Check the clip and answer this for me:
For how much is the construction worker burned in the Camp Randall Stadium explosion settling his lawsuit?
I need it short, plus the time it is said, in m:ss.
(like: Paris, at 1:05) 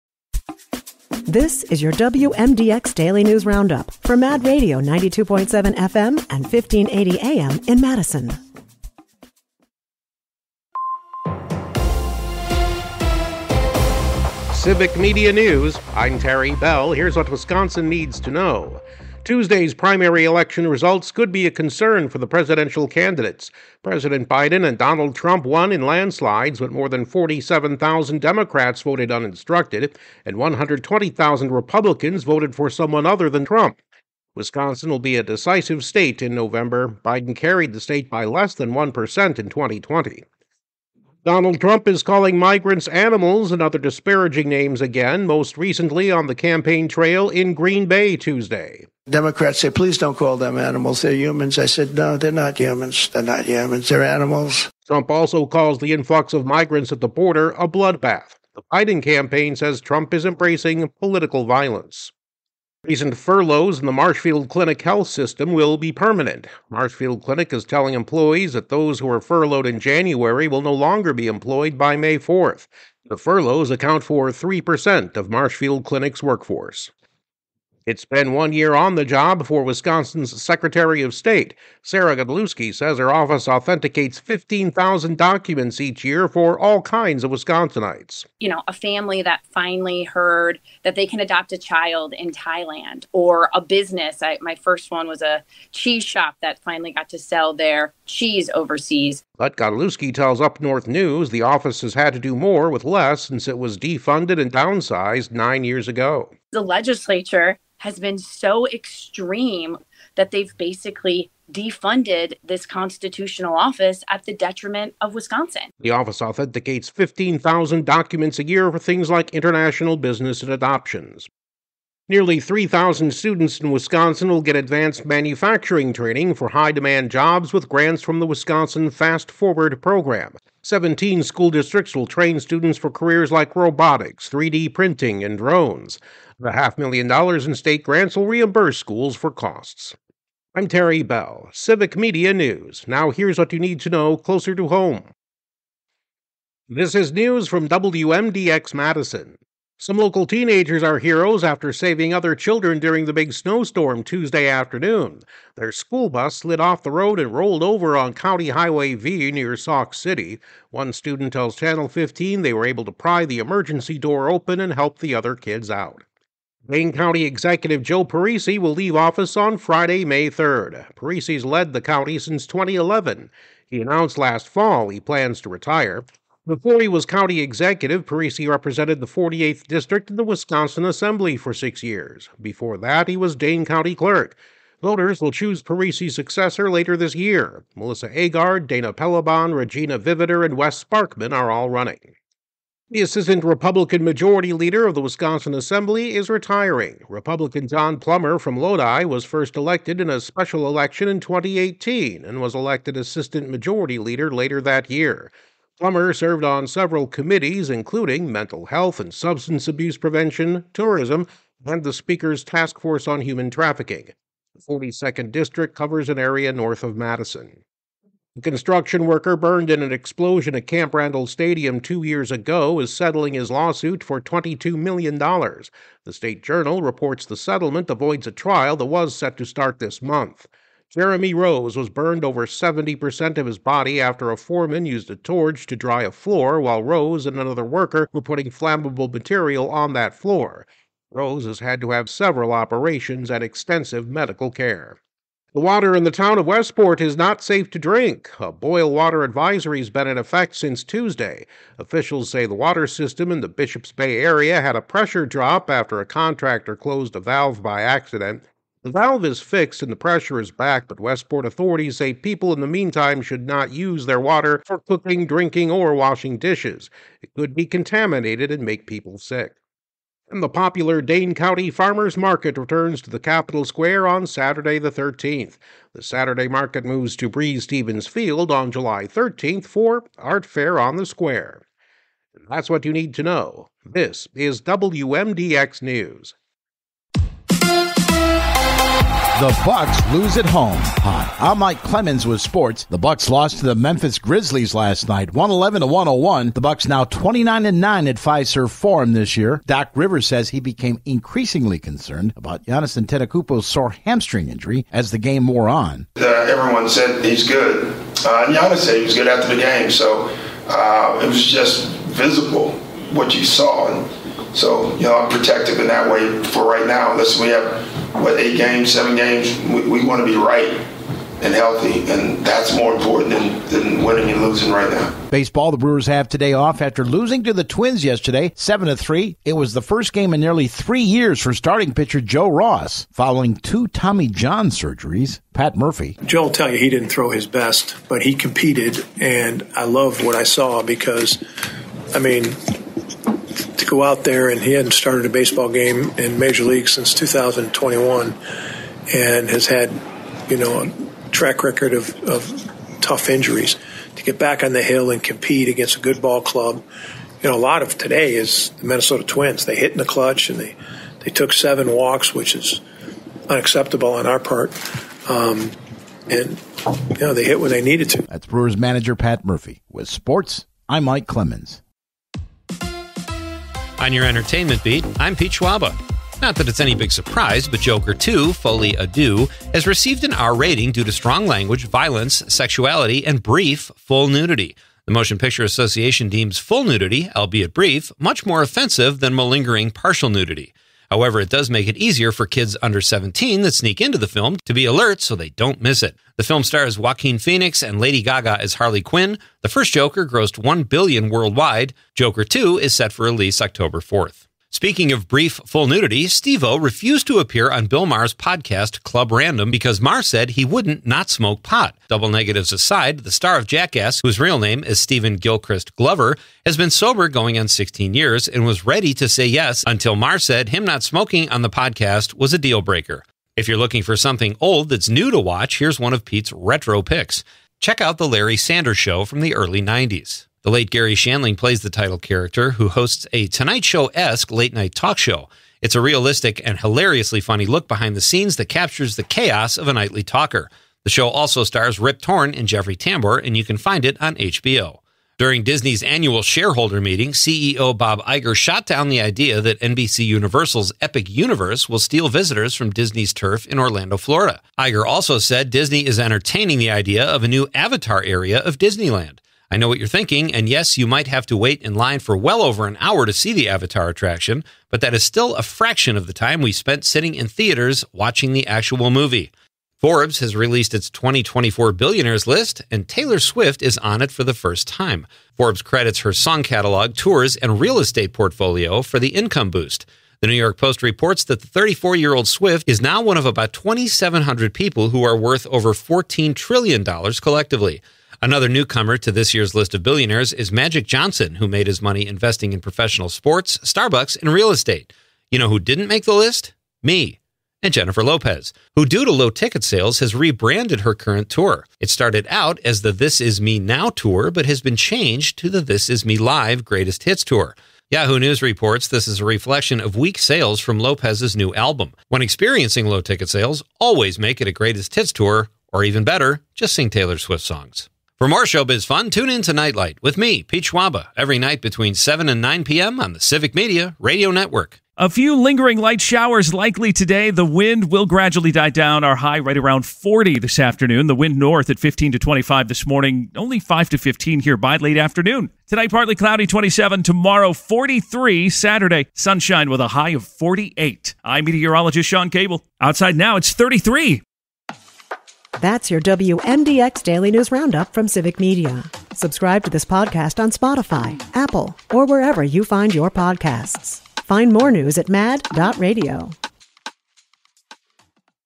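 $22 million, at 3:44.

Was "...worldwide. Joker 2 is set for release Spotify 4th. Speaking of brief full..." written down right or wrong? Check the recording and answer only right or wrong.
wrong.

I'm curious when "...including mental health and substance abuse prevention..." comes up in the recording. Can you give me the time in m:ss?
3:27.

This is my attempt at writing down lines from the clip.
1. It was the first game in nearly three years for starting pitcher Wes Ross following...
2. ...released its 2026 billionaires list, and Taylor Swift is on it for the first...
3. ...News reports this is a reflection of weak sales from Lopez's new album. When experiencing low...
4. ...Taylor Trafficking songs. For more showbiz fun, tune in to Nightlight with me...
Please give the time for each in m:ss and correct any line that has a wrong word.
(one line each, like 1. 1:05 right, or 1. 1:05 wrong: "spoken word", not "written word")
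1. 5:29 wrong: "Joe", not "Wes"
2. 7:50 wrong: "2024", not "2026"
3. 8:28 right
4. 8:37 wrong: "Swift", not "Trafficking".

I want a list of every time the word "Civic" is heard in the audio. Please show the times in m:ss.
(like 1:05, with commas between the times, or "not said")
0:14, 2:21, 8:43, 9:08.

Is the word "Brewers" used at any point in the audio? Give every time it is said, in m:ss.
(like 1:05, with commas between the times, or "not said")
5:25, 6:08.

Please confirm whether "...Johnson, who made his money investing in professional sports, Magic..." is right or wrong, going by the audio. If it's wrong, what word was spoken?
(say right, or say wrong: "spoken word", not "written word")
wrong: "Starbucks", not "Magic".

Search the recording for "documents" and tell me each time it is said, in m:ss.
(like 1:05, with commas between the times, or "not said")
1:25, 1:57.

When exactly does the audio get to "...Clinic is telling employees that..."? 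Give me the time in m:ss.
1:07.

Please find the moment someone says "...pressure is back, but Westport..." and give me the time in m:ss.
4:19.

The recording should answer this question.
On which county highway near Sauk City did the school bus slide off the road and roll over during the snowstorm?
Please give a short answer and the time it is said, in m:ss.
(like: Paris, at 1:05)
County Highway V, at 2:38.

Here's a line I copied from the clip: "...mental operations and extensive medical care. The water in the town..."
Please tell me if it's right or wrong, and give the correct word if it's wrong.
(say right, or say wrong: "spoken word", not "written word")
wrong: "several", not "mental".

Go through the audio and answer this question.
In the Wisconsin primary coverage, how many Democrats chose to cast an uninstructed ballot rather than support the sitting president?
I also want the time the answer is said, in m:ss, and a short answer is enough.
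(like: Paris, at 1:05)
47,000, at 0:27.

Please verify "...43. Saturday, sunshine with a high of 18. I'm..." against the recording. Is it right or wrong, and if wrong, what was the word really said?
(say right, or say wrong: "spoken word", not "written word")
wrong: "48", not "18".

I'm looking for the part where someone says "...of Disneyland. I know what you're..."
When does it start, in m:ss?
7:38.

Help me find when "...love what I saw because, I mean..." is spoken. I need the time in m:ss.
5:39.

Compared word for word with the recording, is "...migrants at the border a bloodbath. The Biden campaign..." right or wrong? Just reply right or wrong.
right.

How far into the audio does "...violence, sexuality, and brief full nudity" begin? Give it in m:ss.
6:21.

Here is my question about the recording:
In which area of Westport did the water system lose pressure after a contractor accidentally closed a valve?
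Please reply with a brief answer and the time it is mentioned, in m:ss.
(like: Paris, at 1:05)
Bishops Bay, at 4:13.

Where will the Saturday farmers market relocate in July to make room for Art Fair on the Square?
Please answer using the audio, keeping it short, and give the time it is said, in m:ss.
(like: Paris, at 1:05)
Breese Stevens Field, at 4:37.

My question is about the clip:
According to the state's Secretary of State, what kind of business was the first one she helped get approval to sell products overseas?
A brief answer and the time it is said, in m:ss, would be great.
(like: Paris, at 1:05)
cheese shop, at 1:35.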